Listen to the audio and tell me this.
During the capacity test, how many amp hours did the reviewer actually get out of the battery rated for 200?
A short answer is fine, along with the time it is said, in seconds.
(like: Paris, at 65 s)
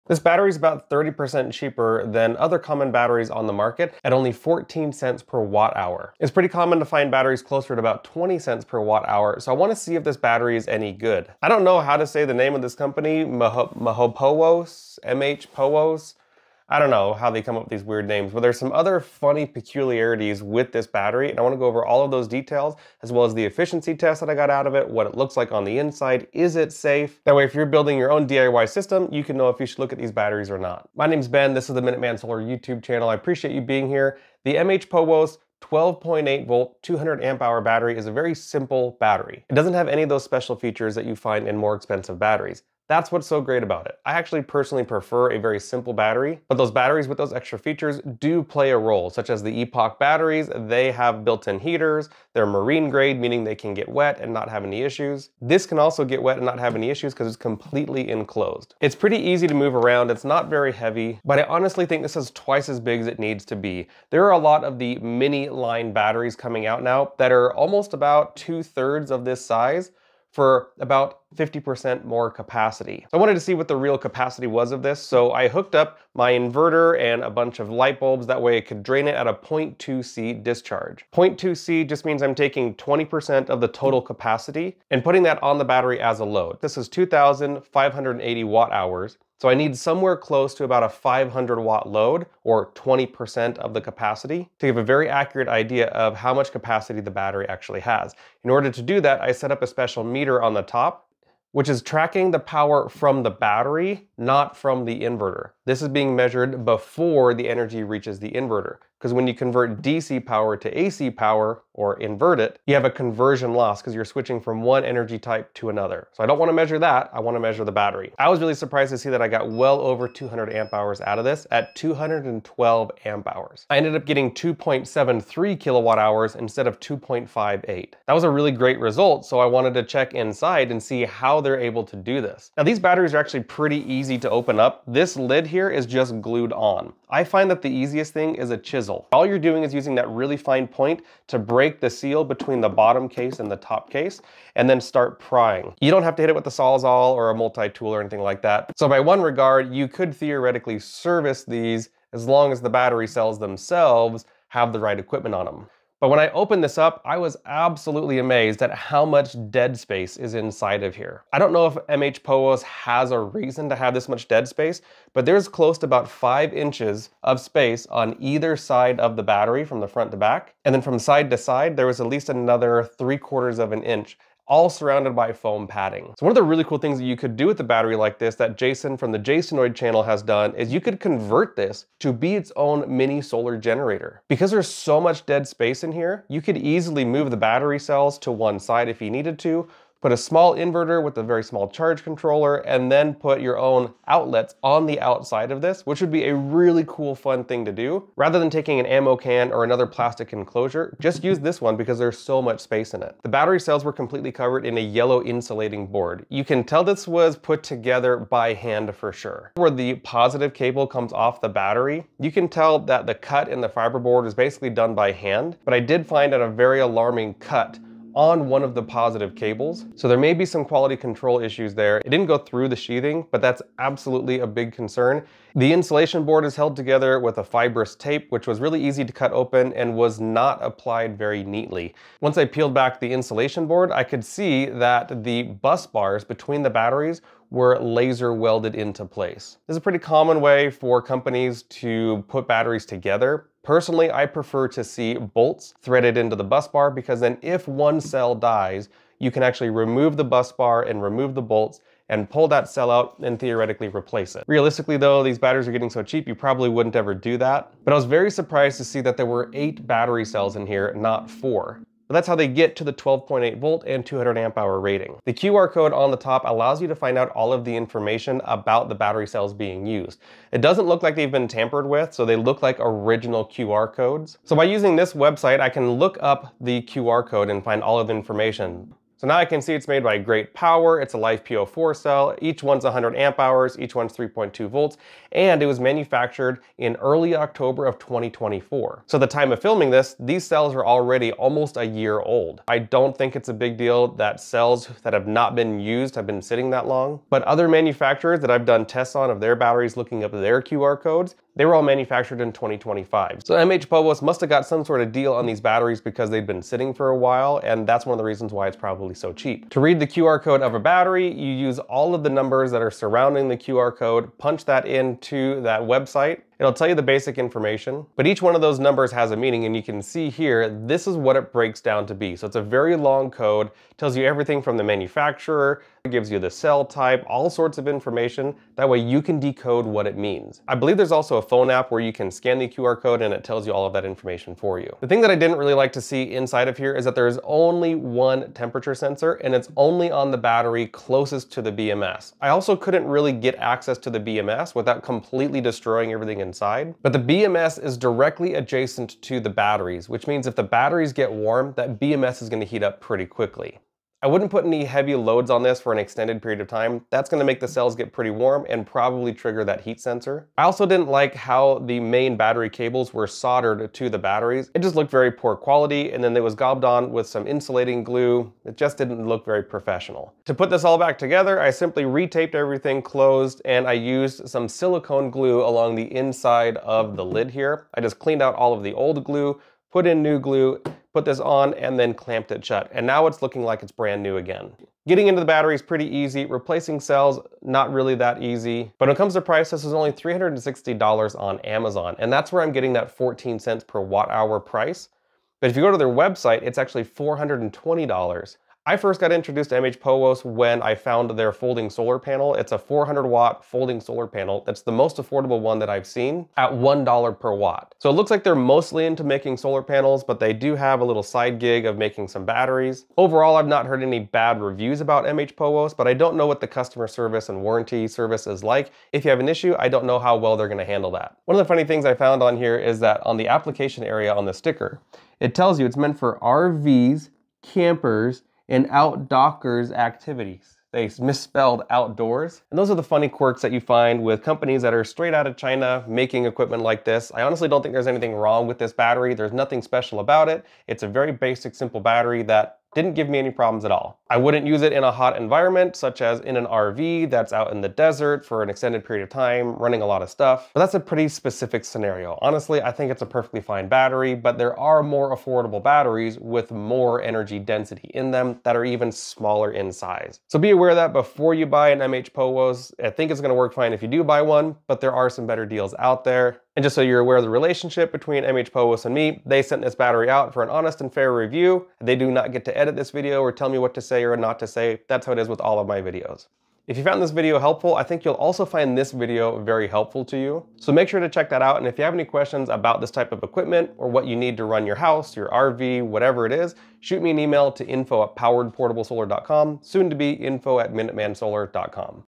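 212, at 121 s.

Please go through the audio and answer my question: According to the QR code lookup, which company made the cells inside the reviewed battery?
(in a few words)
Great Power.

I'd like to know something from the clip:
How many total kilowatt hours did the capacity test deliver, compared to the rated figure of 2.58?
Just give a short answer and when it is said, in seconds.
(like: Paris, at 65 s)
2.73, at 124 s.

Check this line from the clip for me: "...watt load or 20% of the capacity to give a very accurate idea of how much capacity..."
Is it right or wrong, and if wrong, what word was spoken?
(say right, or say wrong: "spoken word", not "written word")
right.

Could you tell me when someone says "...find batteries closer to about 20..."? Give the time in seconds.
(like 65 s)
6 s.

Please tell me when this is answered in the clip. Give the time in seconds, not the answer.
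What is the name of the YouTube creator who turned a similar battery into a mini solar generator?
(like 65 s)
178 s.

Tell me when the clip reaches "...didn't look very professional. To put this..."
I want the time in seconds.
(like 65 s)
368 s.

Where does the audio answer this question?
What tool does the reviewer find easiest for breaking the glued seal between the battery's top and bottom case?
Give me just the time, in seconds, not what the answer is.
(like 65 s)
138 s.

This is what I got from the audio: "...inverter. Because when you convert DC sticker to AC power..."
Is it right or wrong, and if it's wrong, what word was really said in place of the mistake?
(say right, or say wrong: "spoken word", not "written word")
wrong: "power", not "sticker".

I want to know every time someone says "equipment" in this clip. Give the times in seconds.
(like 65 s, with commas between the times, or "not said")
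154 s, 436 s, 483 s.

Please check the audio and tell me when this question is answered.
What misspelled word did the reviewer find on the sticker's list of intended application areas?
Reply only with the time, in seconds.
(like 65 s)
428 s.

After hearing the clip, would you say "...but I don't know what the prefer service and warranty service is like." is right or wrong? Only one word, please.
wrong.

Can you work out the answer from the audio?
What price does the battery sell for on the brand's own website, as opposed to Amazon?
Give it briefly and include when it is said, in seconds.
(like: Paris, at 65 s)
$420, at 397 s.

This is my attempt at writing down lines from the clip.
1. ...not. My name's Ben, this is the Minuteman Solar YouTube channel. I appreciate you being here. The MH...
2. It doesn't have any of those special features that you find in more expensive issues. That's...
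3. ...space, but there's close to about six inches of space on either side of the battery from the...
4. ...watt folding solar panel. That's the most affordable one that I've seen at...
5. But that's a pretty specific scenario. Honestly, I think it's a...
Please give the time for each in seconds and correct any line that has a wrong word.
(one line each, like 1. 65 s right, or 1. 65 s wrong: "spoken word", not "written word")
1. 30 s right
2. 39 s wrong: "batteries", not "issues"
3. 164 s wrong: "five", not "six"
4. 403 s right
5. 450 s right.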